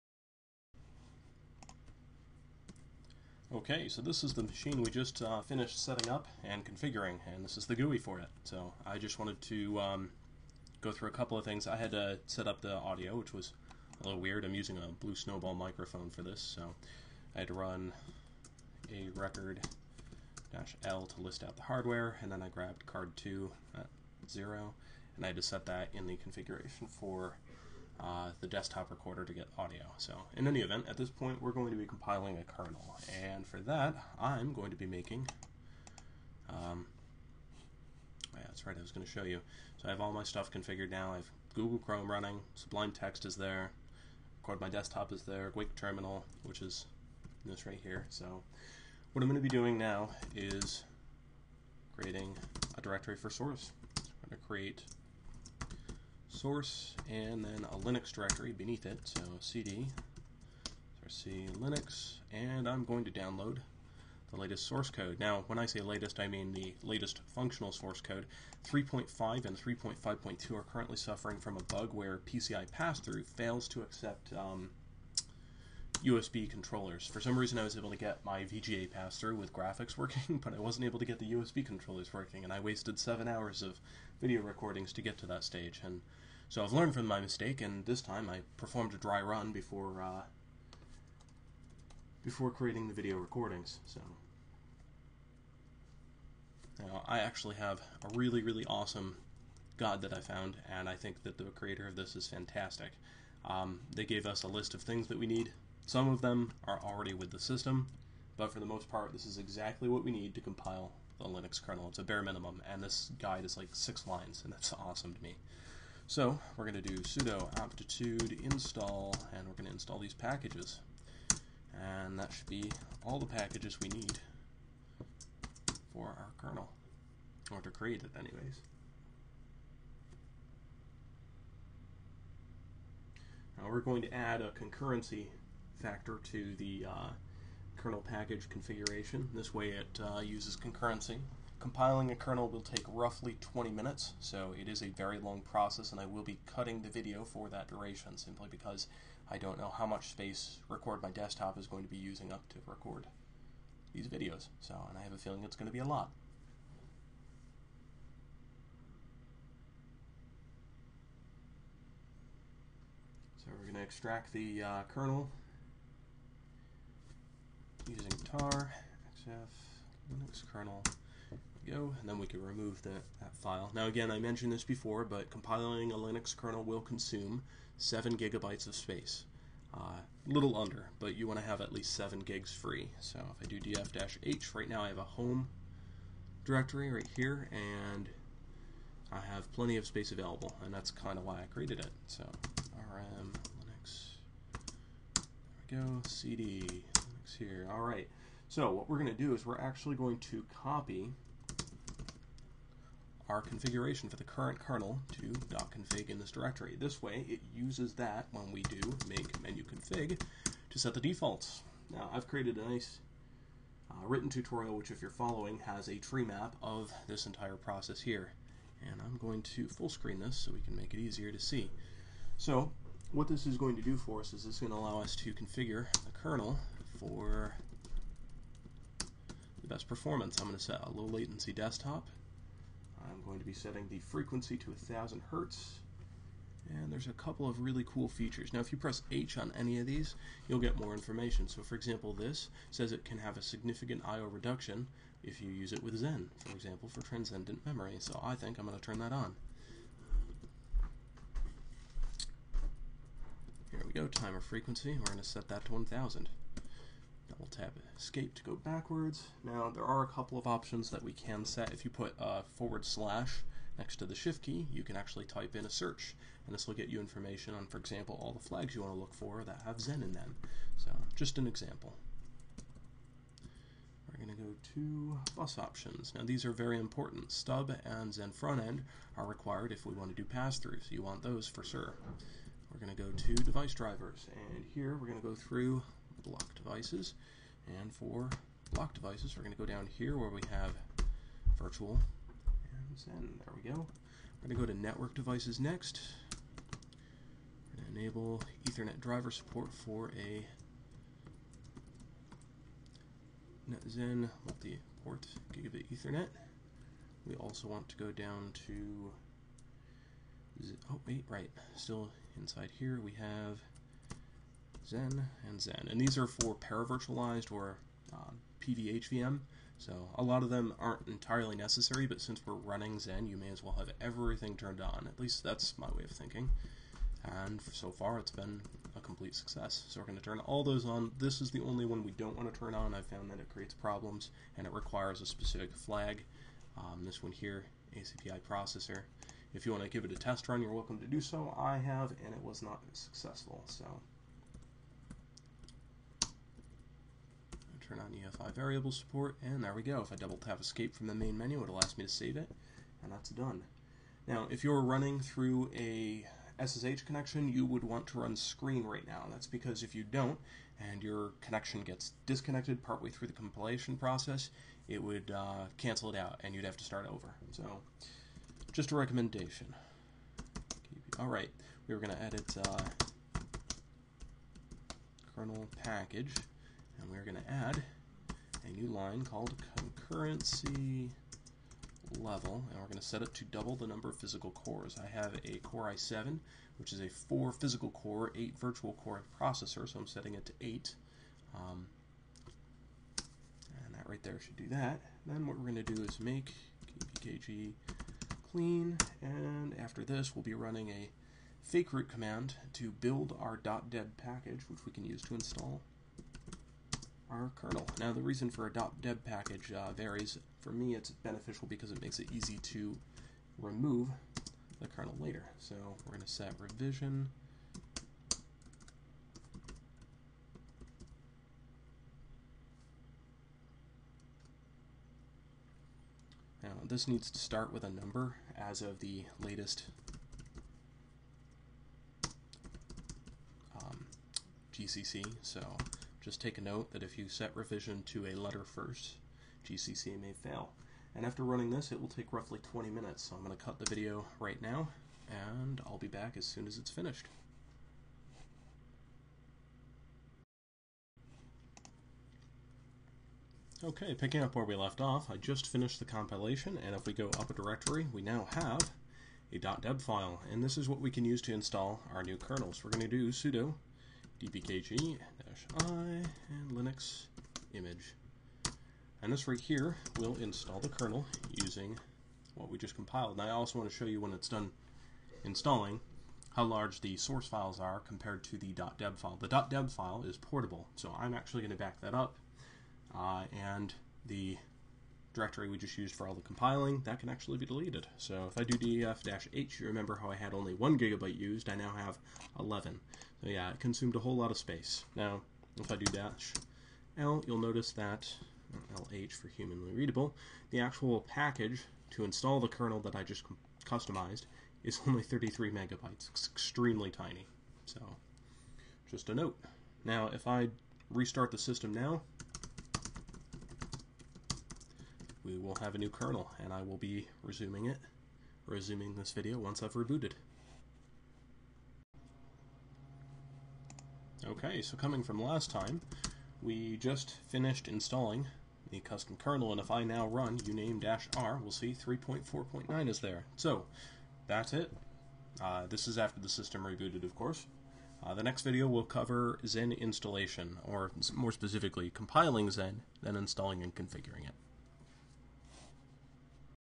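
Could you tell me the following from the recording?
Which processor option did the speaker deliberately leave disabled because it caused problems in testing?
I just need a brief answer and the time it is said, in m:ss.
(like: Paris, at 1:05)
ACPI processor, at 5:37.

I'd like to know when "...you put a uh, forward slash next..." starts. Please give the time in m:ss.
4:21.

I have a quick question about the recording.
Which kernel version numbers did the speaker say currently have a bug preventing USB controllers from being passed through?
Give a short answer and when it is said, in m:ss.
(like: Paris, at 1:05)
3.5 and 3.5.2, at 1:08.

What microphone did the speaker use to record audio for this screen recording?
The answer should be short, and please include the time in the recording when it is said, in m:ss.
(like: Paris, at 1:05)
Blue Snowball, at 0:15.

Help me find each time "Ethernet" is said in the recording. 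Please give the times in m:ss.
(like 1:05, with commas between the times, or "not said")
4:58, 5:05.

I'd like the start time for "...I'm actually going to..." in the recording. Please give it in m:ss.
8:01.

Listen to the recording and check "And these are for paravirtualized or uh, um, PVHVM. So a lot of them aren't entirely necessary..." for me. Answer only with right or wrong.
right.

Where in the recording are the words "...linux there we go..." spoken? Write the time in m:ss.
3:13.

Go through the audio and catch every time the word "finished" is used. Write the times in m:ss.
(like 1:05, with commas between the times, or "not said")
0:05, 7:26, 7:35, 8:47.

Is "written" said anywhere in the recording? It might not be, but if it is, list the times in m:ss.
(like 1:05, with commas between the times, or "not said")
3:34.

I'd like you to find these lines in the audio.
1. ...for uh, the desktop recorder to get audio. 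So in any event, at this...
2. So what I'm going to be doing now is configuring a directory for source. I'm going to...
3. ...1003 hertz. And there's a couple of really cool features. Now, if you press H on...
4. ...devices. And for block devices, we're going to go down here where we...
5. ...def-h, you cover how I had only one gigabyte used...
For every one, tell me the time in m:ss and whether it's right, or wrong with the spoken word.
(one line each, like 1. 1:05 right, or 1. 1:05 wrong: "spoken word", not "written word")
1. 0:26 right
2. 0:48 wrong: "creating", not "configuring"
3. 3:54 wrong: "1000", not "1003"
4. 4:46 right
5. 8:08 wrong: "remember", not "cover".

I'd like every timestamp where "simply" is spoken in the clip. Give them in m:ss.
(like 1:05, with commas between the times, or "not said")
2:28.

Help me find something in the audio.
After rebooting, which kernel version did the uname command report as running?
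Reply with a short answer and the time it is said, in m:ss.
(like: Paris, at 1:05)
3.4.9, at 8:51.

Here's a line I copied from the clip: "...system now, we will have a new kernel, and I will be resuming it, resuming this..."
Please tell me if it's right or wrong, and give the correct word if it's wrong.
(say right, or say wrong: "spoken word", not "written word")
right.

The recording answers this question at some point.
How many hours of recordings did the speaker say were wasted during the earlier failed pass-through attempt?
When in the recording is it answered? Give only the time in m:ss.
1:22.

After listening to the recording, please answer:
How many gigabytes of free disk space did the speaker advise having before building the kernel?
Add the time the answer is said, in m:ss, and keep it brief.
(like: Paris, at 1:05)
7, at 2:57.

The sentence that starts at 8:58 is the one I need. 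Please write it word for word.
Uh, the next video will cover Xen installation, or more specifically, compiling Xen, then installing and configuring it.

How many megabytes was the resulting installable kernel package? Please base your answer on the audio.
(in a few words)
33 MB.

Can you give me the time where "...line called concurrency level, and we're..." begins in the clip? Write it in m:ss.
6:18.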